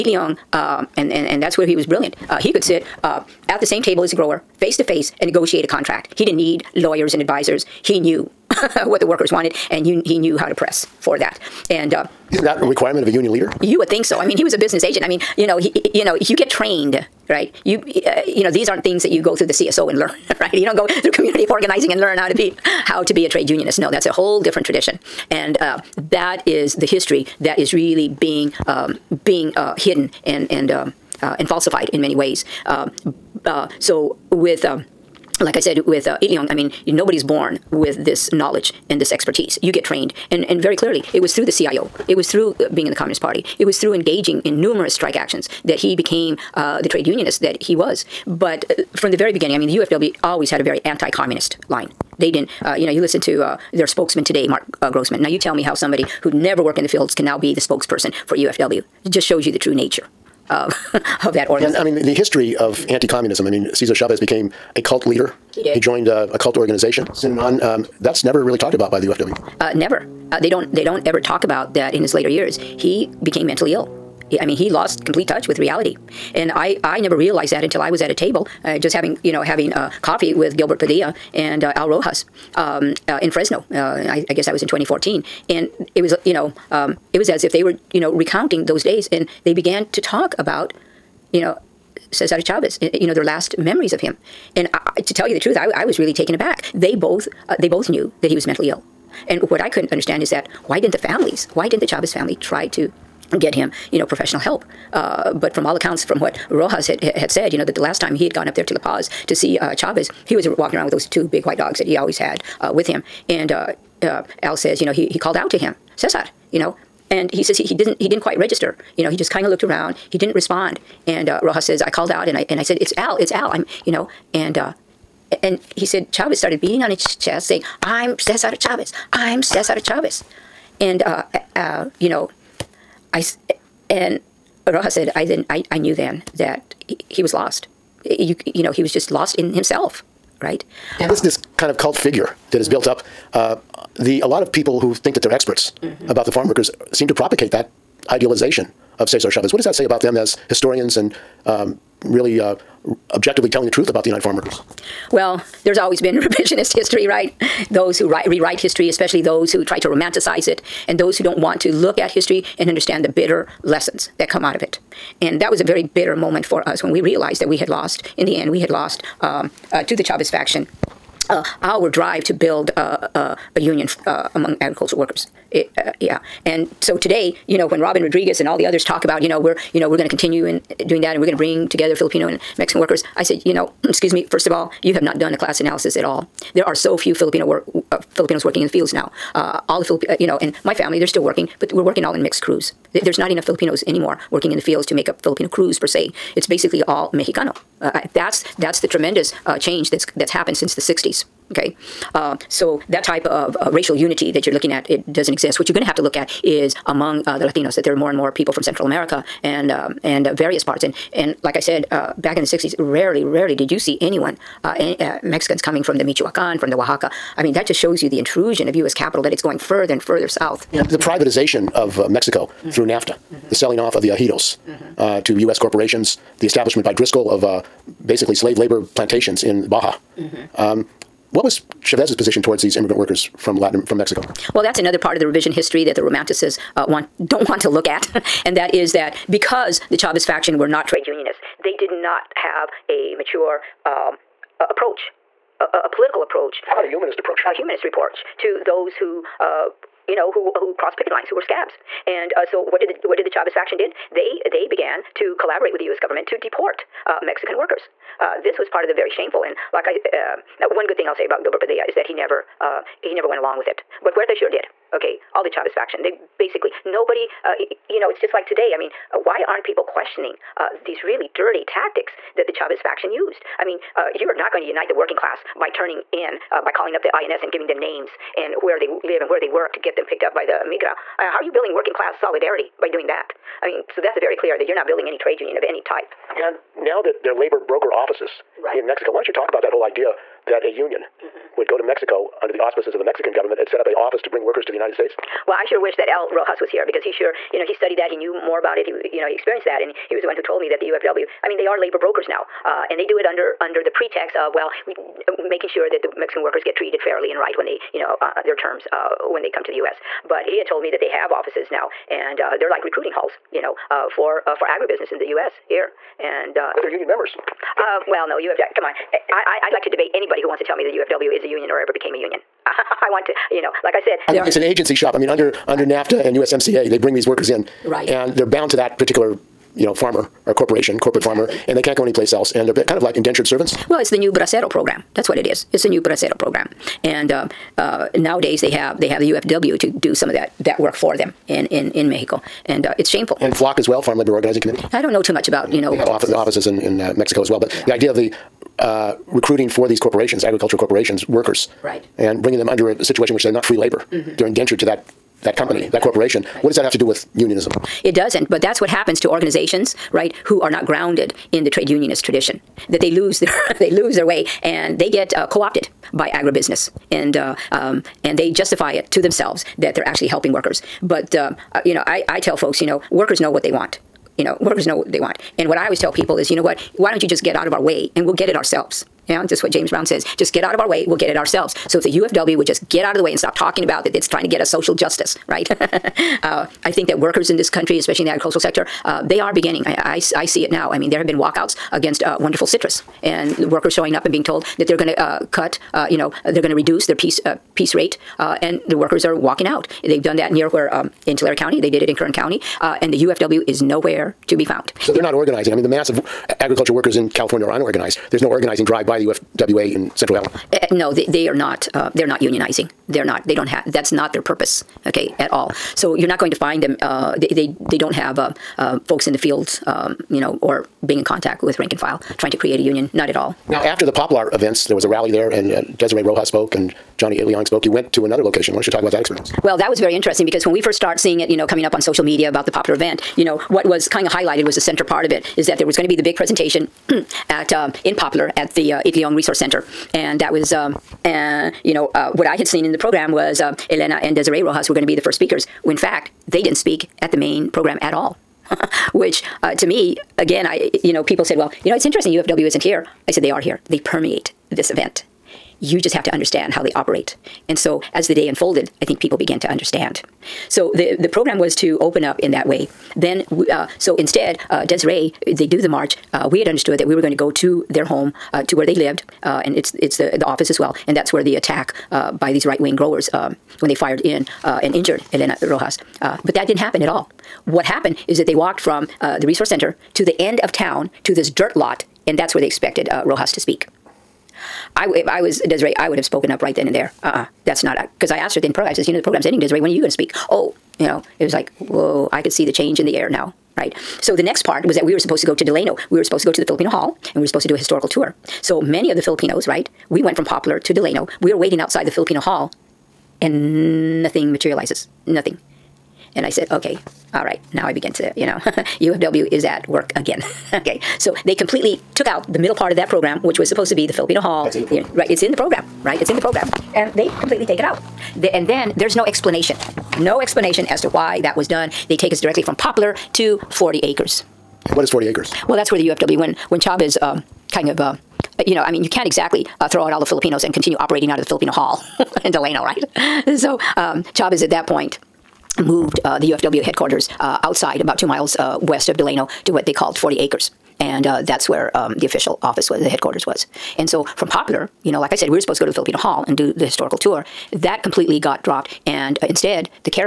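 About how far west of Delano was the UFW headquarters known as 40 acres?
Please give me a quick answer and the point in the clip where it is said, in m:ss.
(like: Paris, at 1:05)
2 miles, at 8:58.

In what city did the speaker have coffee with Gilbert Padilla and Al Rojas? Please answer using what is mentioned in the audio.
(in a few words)
Fresno.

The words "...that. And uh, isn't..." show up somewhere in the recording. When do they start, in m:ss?
0:11.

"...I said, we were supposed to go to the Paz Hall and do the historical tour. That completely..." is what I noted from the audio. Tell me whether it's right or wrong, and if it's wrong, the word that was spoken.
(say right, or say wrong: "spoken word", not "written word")
wrong: "Filipino", not "Paz".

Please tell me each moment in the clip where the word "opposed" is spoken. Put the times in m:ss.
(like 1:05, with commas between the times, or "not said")
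not said.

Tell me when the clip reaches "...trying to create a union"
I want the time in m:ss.
7:02.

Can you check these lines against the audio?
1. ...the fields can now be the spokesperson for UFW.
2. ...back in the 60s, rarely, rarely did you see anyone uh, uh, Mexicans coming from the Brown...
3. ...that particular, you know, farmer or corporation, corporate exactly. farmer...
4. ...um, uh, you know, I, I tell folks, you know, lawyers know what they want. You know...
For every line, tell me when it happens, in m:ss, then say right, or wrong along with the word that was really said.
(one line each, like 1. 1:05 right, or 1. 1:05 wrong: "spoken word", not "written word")
1. 0:56 right
2. 3:32 wrong: "Michoacan", not "Brown"
3. 5:28 right
4. 6:11 wrong: "workers", not "lawyers".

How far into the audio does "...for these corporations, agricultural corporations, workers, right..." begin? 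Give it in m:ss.
5:49.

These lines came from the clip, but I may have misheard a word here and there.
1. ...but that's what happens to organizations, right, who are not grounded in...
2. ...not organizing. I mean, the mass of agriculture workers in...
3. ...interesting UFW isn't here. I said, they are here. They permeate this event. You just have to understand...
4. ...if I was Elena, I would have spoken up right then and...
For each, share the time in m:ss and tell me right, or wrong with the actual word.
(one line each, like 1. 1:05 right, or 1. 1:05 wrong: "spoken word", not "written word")
1. 5:58 right
2. 6:45 right
3. 7:32 right
4. 8:05 wrong: "Desiree", not "Elena".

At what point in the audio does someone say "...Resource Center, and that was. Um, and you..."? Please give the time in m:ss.
7:19.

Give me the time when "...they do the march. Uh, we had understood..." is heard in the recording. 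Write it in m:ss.
7:45.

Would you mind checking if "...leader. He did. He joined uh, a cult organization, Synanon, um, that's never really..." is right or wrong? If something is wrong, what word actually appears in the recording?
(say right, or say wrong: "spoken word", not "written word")
right.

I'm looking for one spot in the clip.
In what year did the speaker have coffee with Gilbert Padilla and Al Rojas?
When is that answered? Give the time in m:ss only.
1:24.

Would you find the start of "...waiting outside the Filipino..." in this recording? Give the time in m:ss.
8:21.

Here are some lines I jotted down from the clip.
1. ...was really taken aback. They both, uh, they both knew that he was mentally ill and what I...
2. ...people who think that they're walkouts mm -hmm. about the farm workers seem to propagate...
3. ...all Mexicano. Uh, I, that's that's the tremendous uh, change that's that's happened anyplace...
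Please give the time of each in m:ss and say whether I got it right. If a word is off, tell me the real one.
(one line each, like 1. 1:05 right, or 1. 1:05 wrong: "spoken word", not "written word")
1. 1:35 right
2. 2:24 wrong: "experts", not "walkouts"
3. 3:16 wrong: "since", not "anyplace".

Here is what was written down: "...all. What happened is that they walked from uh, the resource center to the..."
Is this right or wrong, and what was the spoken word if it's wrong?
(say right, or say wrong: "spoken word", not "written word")
right.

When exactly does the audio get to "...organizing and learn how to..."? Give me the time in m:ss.
0:21.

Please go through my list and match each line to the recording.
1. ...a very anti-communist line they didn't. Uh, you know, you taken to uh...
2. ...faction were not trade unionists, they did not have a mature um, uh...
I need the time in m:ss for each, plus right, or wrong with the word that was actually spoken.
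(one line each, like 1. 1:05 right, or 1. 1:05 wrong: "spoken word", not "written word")
1. 0:50 wrong: "listen", not "taken"
2. 4:00 right.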